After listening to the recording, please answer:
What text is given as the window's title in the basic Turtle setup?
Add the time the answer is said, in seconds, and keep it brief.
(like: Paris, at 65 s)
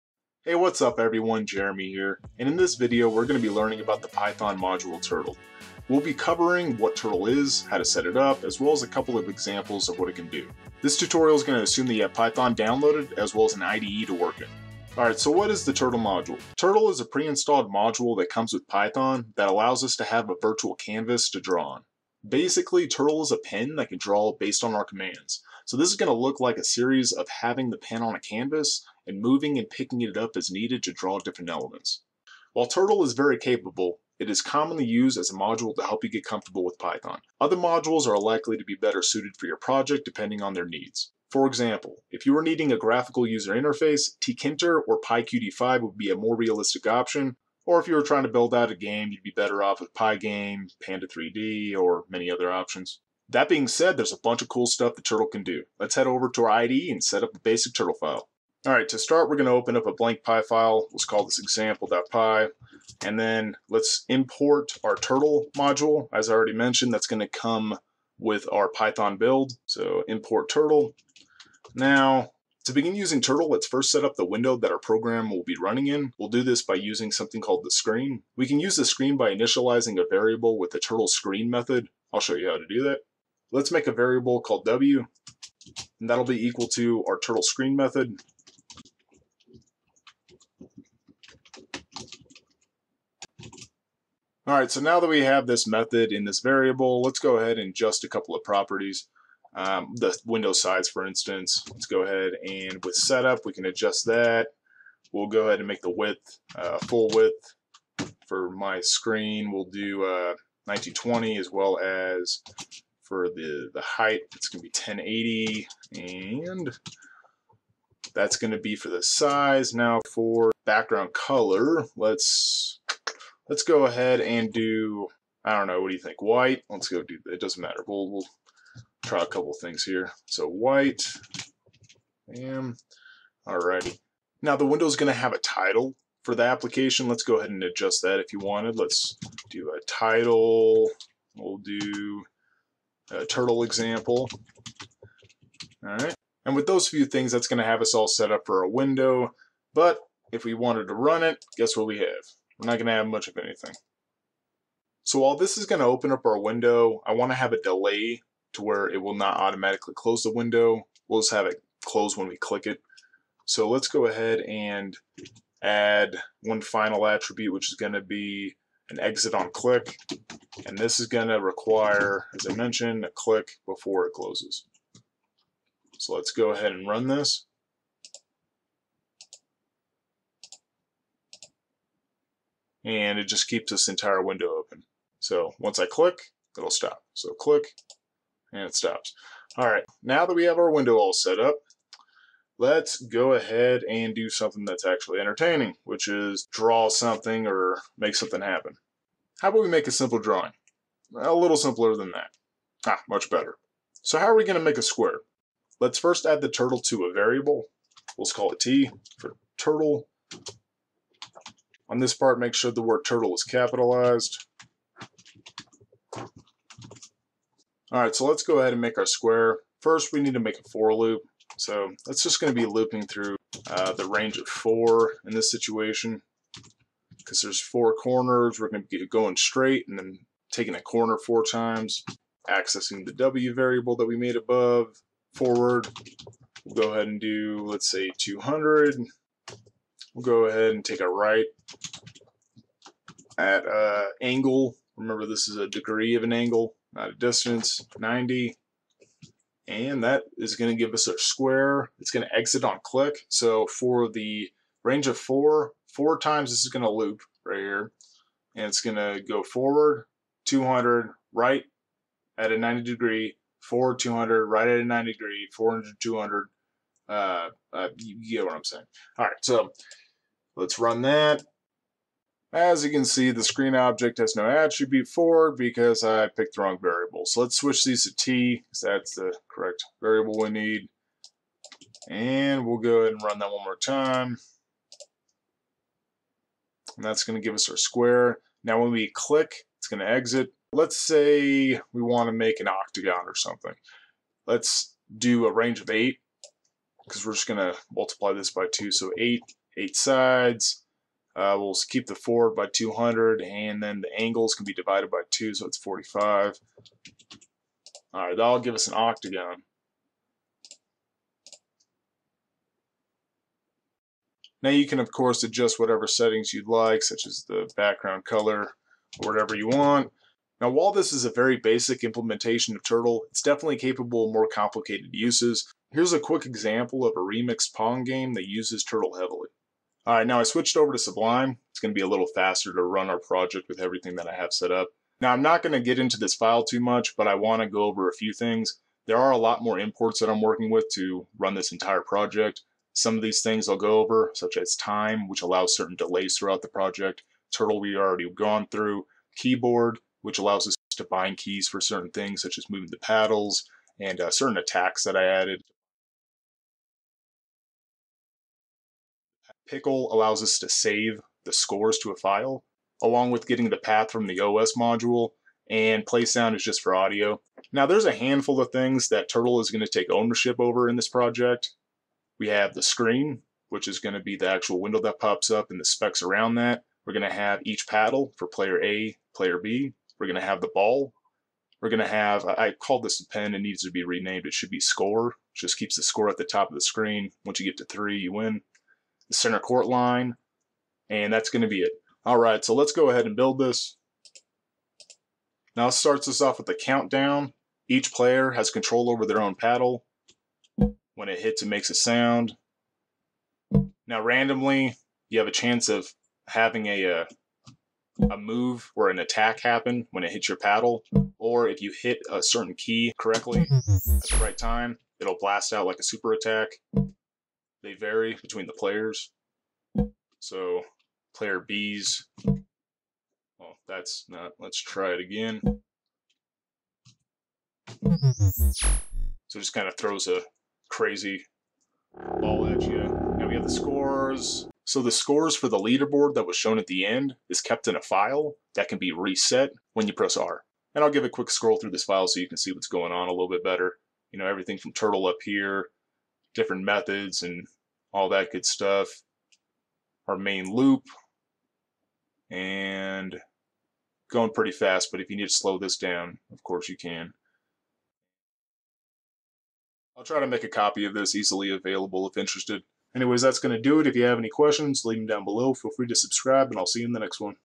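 turtle example, at 143 s.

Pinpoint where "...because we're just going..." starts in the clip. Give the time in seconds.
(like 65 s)
297 s.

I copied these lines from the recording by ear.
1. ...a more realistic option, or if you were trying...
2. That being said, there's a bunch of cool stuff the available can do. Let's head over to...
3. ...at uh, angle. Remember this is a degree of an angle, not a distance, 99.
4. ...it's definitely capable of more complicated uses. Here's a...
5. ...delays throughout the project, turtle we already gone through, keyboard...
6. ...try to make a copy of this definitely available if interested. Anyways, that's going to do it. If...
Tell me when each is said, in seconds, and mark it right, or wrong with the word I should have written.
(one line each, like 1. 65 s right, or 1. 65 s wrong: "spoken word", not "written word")
1. 46 s right
2. 53 s wrong: "turtle", not "available"
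3. 243 s wrong: "90", not "99"
4. 323 s right
5. 345 s right
6. 460 s wrong: "easily", not "definitely".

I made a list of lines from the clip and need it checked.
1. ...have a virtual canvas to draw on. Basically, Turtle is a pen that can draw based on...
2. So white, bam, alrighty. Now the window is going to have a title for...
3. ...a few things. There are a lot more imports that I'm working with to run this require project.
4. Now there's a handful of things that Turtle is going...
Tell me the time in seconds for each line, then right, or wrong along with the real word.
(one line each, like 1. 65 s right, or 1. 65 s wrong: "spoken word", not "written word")
1. 20 s right
2. 130 s right
3. 338 s wrong: "entire", not "require"
4. 367 s right.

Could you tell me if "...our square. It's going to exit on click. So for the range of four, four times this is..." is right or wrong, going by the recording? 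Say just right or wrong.
right.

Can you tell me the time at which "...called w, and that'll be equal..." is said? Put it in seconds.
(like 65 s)
84 s.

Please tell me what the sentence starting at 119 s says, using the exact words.
Now for background color, let's let's go ahead and do, I don't know, what do you think, white?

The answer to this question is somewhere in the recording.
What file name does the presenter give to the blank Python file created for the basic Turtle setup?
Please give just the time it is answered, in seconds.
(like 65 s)
61 s.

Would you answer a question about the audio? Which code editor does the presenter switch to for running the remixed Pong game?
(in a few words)
Sublime.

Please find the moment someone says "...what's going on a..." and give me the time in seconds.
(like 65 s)
442 s.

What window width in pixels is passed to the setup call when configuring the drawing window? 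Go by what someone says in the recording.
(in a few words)
1920.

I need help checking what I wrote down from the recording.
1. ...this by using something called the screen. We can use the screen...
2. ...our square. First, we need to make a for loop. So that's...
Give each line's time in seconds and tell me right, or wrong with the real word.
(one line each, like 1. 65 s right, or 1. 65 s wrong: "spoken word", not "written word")
1. 76 s right
2. 218 s right.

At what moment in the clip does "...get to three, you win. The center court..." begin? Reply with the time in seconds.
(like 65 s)
387 s.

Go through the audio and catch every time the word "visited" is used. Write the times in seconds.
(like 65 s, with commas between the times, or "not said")
not said.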